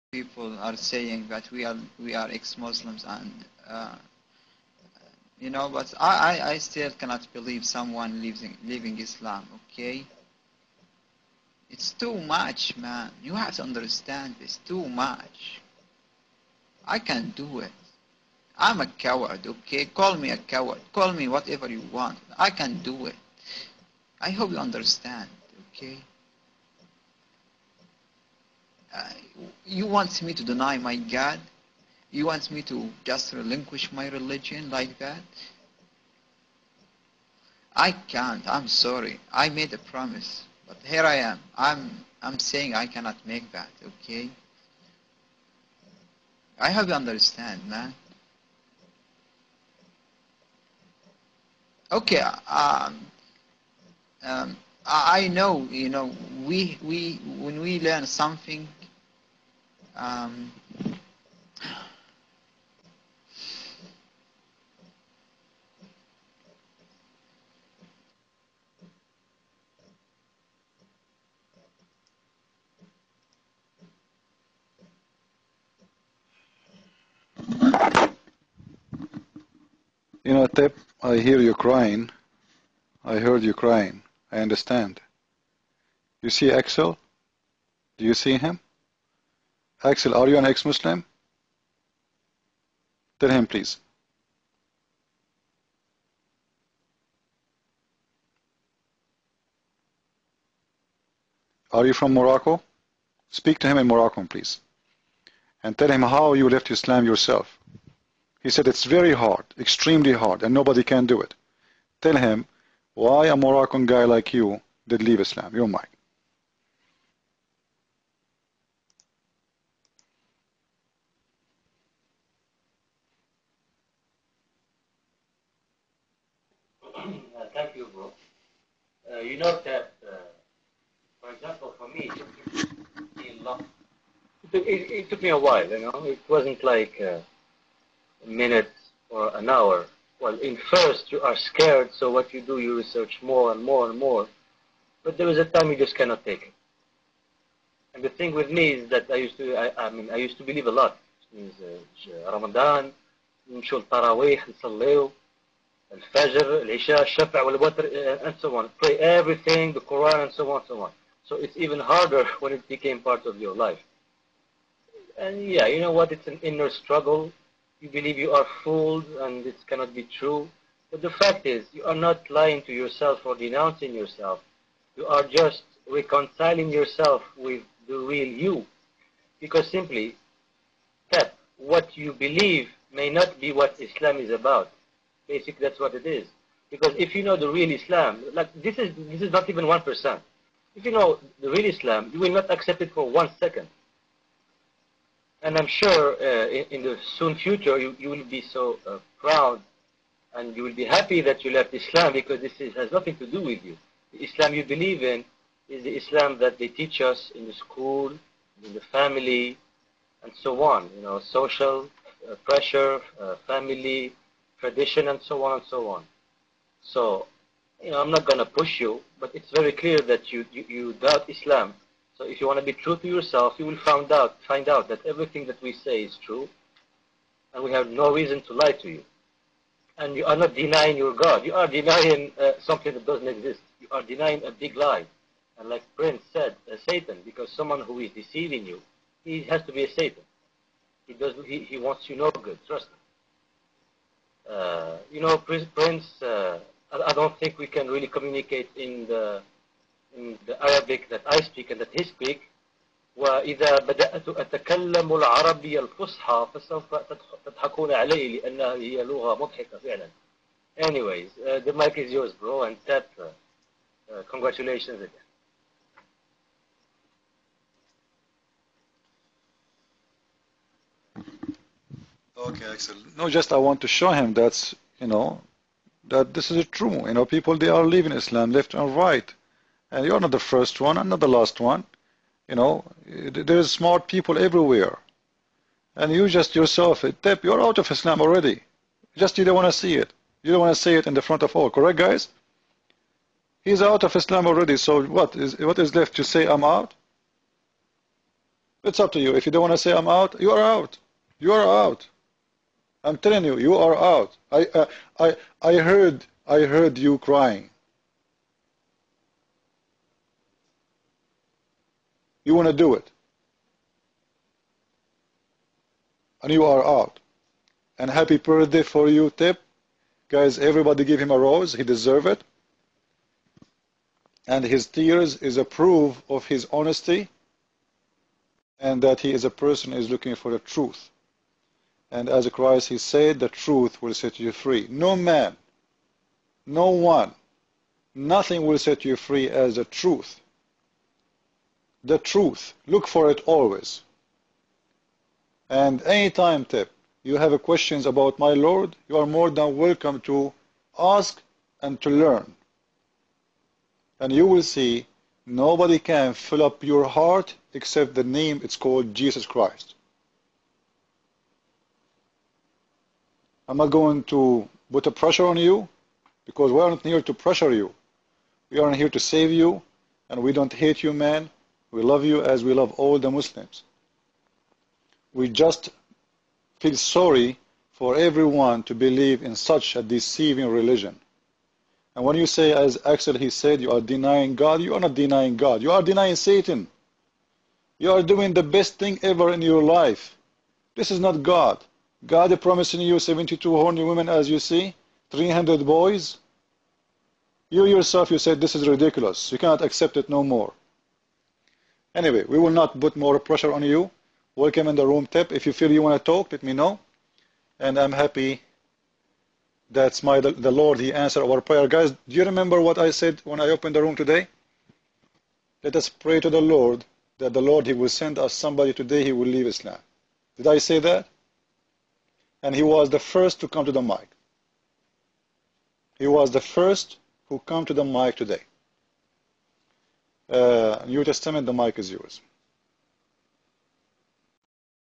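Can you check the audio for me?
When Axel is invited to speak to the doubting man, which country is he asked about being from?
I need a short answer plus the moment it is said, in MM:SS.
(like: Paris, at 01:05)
Morocco, at 01:42.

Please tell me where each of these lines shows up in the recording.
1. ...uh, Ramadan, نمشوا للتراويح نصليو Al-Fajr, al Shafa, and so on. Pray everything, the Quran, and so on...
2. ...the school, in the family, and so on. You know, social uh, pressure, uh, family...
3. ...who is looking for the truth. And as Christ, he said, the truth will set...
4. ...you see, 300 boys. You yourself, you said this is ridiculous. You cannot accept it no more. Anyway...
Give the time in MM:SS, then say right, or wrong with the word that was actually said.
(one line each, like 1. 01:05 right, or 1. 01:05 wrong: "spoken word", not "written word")
1. 02:31 right
2. 03:27 right
3. 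05:29 right
4. 06:34 right.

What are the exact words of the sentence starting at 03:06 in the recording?
Because if you know the real Islam, like this is this is not even one percent.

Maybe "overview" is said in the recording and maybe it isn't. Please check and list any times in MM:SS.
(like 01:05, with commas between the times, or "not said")
not said.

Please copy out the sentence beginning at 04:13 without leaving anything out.
وإذا بدأت أتكلم العربية الفصحى فسوف تضحكون علي لأنها هي لغة مضحكة فعلا.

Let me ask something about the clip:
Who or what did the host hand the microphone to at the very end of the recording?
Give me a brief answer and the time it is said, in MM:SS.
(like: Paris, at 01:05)
New Testament, at 07:11.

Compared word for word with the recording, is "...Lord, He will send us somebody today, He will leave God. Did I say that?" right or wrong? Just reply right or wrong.
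wrong.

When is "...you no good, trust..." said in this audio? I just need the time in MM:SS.
04:02.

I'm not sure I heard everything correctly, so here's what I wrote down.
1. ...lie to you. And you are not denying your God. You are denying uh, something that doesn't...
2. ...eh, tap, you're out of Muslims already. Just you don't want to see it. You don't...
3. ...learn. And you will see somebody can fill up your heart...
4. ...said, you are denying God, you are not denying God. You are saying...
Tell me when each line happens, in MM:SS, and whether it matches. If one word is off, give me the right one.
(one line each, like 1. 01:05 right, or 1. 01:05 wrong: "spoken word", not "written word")
1. 03:48 right
2. 04:47 wrong: "Islam", not "Muslims"
3. 05:52 wrong: "nobody", not "somebody"
4. 06:23 wrong: "denying", not "saying".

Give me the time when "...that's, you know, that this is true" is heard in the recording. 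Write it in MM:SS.
04:34.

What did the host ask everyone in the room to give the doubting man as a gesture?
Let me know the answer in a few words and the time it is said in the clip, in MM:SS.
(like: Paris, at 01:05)
a rose, at 05:21.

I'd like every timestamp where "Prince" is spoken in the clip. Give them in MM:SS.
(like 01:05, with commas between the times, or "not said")
03:55, 04:05.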